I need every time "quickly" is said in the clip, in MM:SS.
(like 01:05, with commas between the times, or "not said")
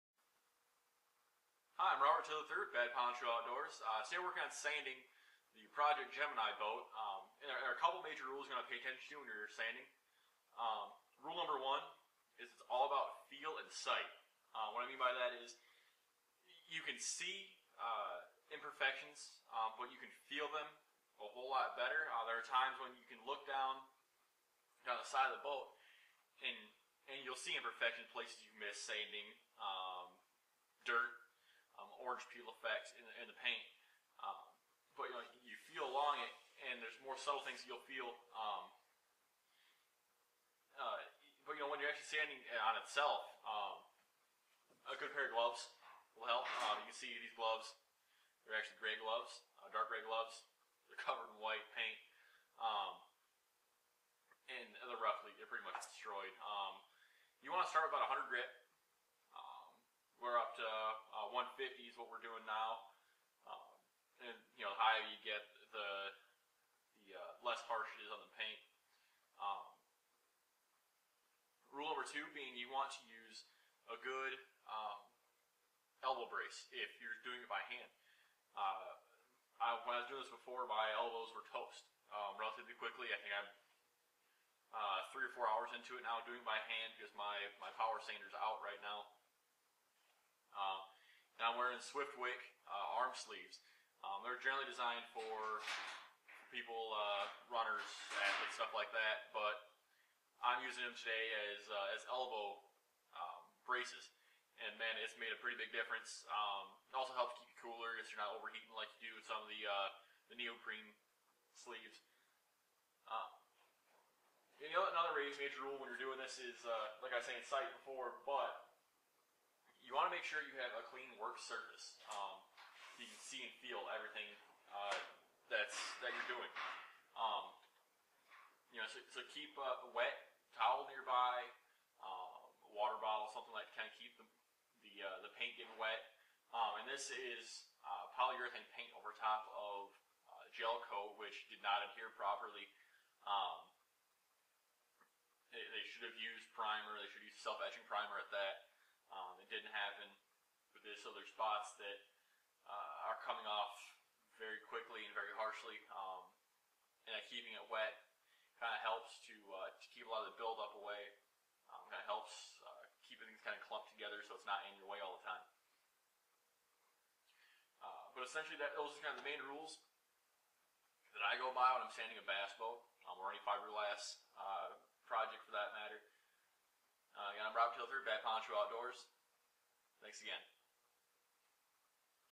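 01:22, 02:34.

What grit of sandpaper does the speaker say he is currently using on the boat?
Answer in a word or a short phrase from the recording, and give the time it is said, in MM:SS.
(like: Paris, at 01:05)
150, at 01:01.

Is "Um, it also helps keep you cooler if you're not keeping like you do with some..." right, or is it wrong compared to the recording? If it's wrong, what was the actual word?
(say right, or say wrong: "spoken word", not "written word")
wrong: "overheating", not "keeping".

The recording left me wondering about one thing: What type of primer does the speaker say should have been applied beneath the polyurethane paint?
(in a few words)
Self-etching primer.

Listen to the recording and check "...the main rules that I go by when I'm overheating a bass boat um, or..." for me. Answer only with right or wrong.
wrong.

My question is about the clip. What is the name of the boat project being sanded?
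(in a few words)
Project Gemini.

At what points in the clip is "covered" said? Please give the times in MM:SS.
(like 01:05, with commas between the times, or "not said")
00:51.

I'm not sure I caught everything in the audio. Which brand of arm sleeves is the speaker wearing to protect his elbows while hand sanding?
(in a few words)
Swiftwick.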